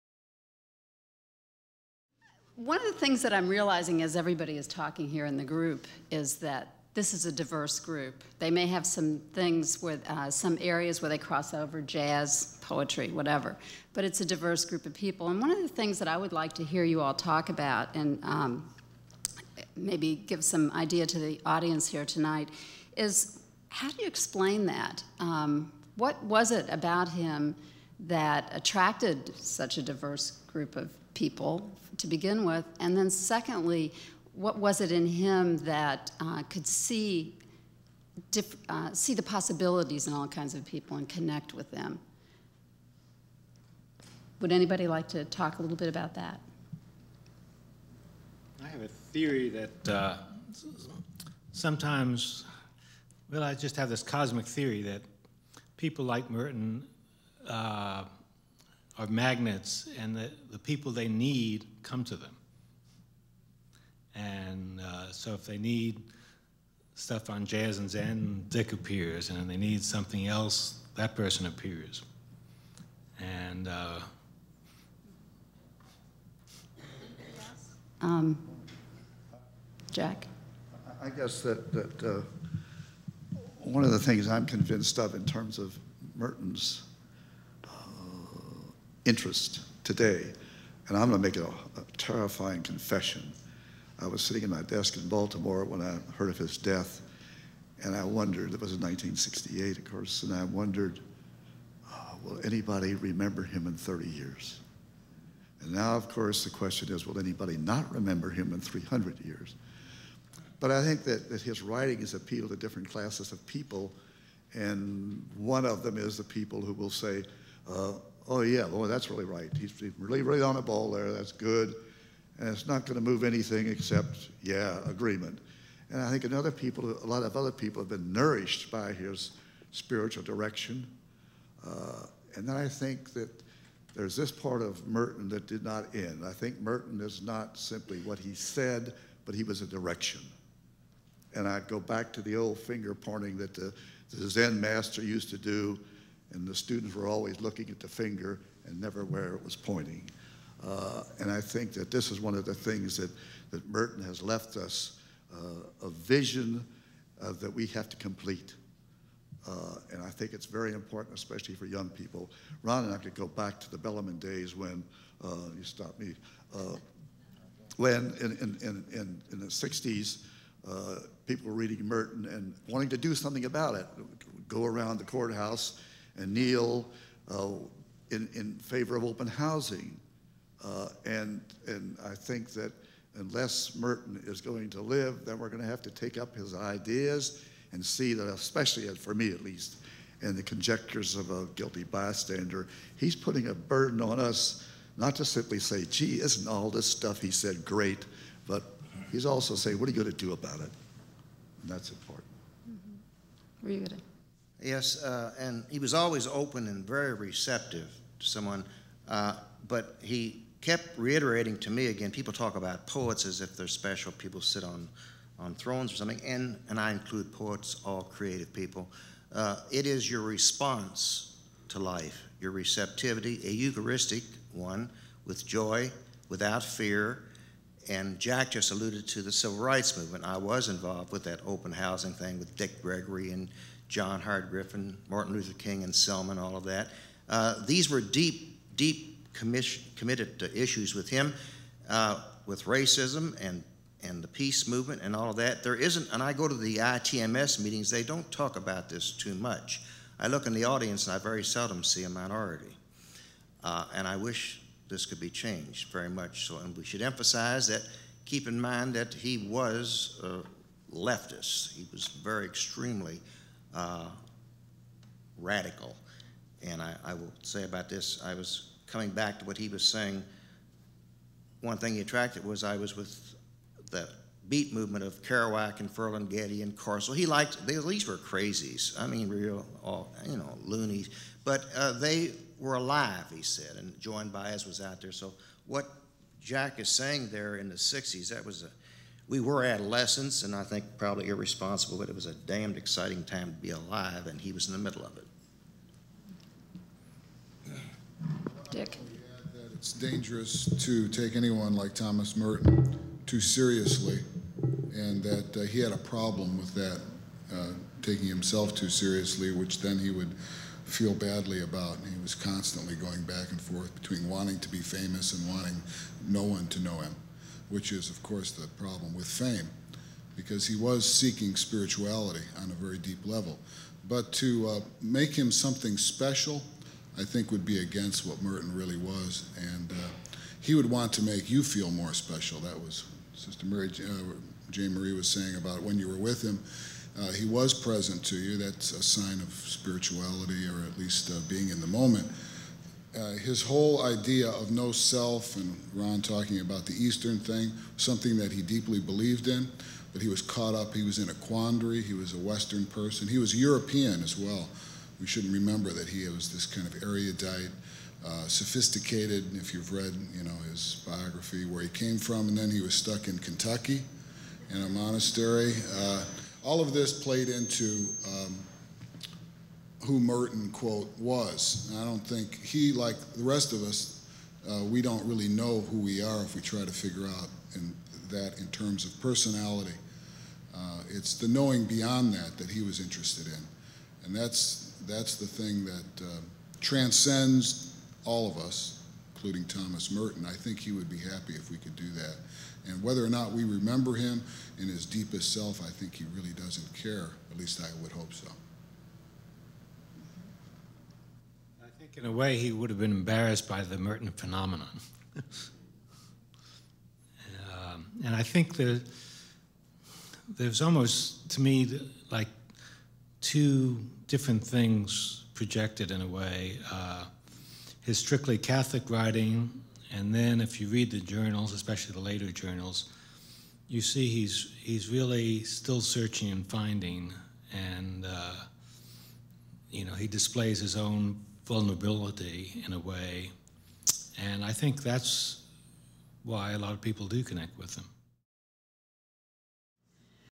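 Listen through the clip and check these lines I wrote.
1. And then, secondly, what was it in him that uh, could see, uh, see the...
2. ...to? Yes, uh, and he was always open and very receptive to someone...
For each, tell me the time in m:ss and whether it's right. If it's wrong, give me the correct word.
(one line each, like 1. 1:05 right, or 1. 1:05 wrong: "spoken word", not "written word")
1. 0:32 right
2. 3:23 right.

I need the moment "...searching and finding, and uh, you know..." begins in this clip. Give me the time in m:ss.
7:06.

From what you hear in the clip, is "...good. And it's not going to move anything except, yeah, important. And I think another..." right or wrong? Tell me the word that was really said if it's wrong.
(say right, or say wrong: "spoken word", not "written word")
wrong: "agreement", not "important".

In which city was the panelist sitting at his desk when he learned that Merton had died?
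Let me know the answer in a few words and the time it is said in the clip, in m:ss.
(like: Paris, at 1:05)
Baltimore, at 1:35.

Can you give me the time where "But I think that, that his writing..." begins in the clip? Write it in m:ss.
1:50.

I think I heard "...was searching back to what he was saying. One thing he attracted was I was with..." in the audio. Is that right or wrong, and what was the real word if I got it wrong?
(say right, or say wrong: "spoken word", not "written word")
wrong: "coming", not "searching".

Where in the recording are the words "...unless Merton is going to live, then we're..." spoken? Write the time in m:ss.
3:03.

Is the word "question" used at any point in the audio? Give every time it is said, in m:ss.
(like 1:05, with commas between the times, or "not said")
1:46.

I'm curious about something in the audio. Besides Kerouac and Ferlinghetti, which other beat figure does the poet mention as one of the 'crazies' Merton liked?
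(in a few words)
Corso.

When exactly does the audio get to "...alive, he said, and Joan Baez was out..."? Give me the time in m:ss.
4:42.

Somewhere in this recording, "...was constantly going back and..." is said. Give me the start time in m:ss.
5:12.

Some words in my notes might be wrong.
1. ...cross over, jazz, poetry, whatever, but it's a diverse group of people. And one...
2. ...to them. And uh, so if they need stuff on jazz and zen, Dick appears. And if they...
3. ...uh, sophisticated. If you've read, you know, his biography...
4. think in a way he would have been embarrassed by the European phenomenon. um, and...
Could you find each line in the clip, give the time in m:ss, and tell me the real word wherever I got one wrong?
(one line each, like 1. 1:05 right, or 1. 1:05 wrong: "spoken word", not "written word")
1. 0:11 right
2. 1:02 right
3. 5:58 right
4. 6:42 wrong: "Merton", not "European".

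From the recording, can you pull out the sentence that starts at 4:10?
I look in the audience and I very seldom see a minority.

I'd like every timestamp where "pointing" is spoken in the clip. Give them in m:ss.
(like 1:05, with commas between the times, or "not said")
2:22, 2:29.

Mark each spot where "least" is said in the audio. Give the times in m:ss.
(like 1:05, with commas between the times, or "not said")
3:09, 5:40, 6:37.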